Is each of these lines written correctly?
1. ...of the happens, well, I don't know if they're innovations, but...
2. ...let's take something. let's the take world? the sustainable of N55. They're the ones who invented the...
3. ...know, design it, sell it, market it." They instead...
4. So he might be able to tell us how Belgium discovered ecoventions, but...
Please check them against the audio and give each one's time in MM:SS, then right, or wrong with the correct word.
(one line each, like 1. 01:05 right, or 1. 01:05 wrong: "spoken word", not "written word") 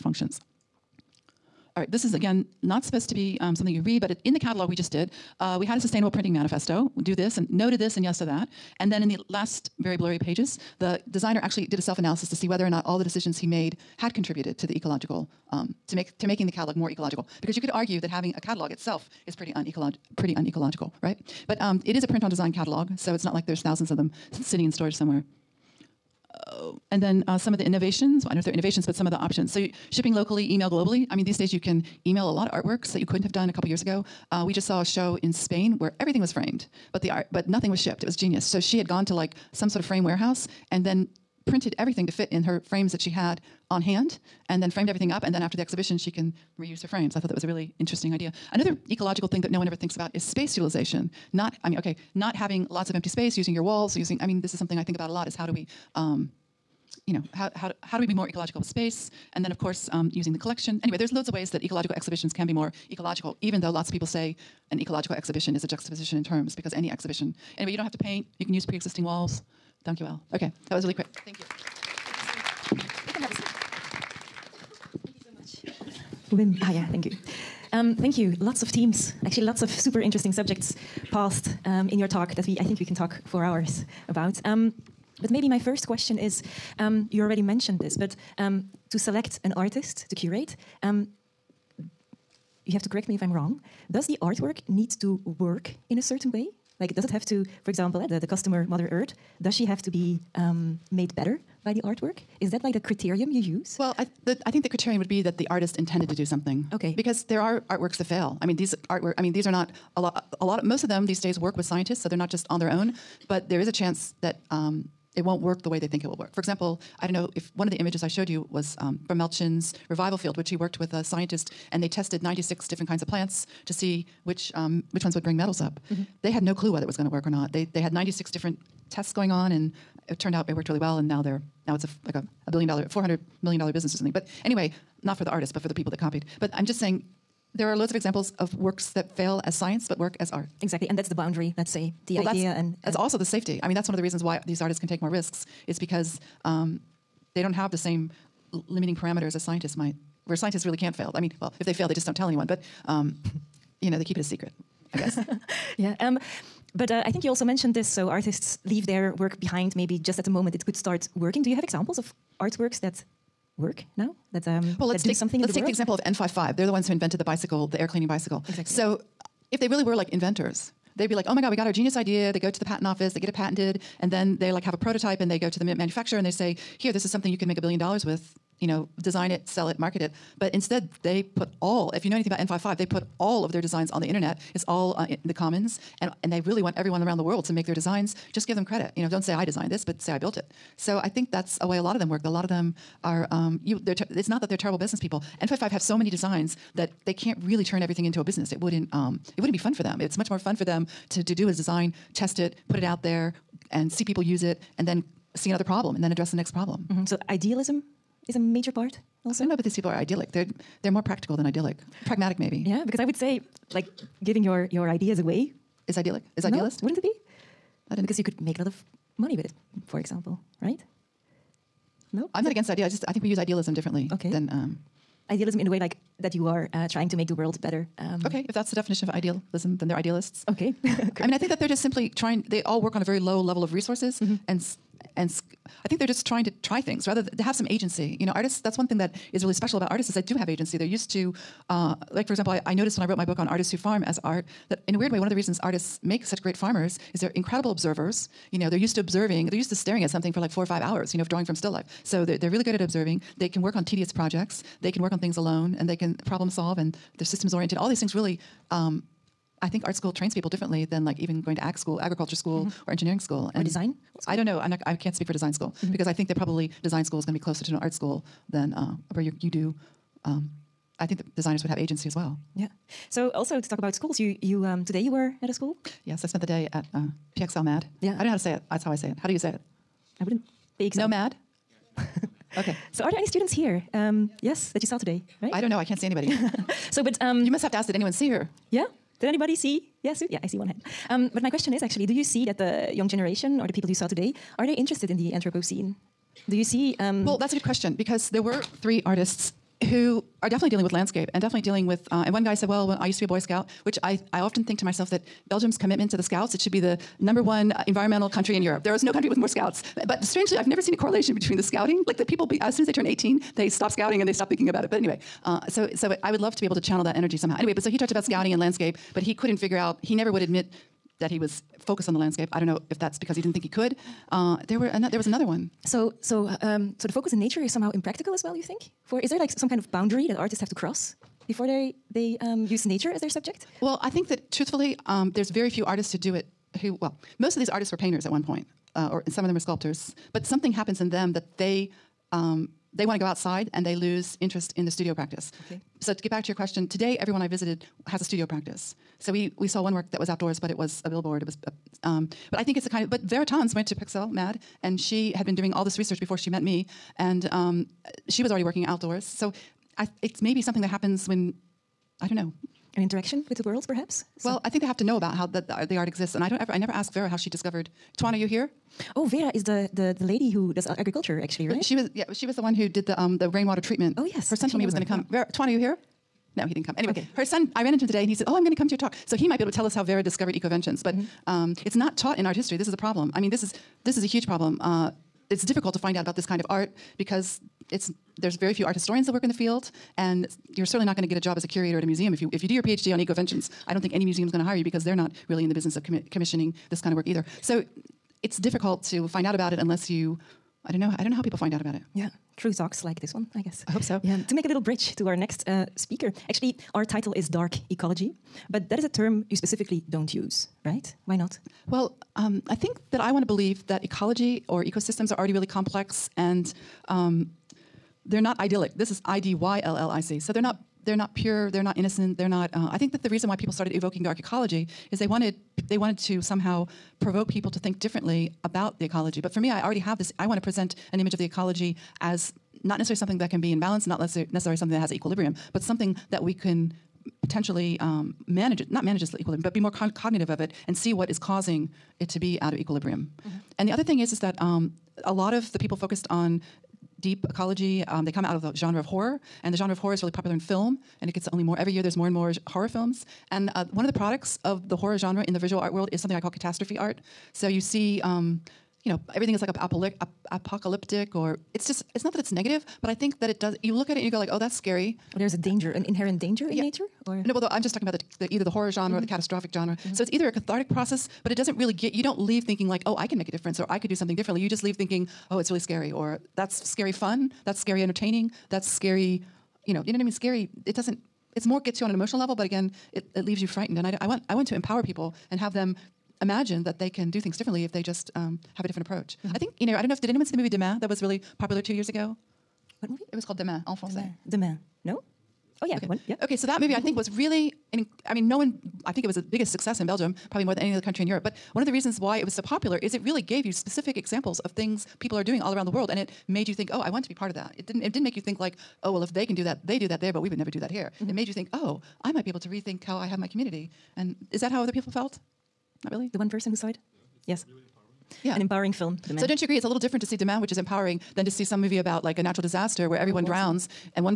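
1. 00:27 wrong: "innovations", not "happens"
2. 02:44 wrong: "example", not "sustainable"
3. 02:58 wrong: "But", not "They"
4. 06:19 wrong: "Vera", not "Belgium".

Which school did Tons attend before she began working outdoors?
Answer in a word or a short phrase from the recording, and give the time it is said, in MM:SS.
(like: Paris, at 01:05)
PXL-MAD, at 05:53.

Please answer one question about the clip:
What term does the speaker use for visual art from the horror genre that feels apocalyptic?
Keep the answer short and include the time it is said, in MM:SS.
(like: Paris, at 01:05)
catastrophe art, at 07:36.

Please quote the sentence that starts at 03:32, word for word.
Yeah, because I would say like giving your your ideas away is idyllic.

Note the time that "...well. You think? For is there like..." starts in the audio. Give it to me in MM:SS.
05:28.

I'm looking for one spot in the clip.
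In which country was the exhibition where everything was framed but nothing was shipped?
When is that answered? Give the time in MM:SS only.
00:35.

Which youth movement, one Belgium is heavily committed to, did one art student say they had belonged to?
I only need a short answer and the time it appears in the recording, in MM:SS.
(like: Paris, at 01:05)
Boy Scout, at 05:03.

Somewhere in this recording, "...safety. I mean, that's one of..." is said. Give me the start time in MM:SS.
02:23.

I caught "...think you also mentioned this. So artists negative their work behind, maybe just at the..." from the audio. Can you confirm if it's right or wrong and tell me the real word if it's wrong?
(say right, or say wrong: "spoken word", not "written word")
wrong: "leave", not "negative".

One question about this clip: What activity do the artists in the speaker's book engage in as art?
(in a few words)
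farm.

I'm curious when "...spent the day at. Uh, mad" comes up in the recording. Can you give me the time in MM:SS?
04:36.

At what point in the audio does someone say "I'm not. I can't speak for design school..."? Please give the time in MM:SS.
04:24.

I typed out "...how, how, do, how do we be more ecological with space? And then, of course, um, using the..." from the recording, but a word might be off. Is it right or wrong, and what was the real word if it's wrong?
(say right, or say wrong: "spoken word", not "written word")
right.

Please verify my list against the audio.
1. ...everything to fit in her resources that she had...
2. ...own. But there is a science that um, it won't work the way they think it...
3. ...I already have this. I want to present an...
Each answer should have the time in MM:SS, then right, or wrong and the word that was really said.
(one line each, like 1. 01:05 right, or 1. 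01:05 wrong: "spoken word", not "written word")
1. 00:41 wrong: "frames", not "resources"
2. 01:52 wrong: "chance", not "science"
3. 07:09 right.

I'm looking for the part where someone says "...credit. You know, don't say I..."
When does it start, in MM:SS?
03:08.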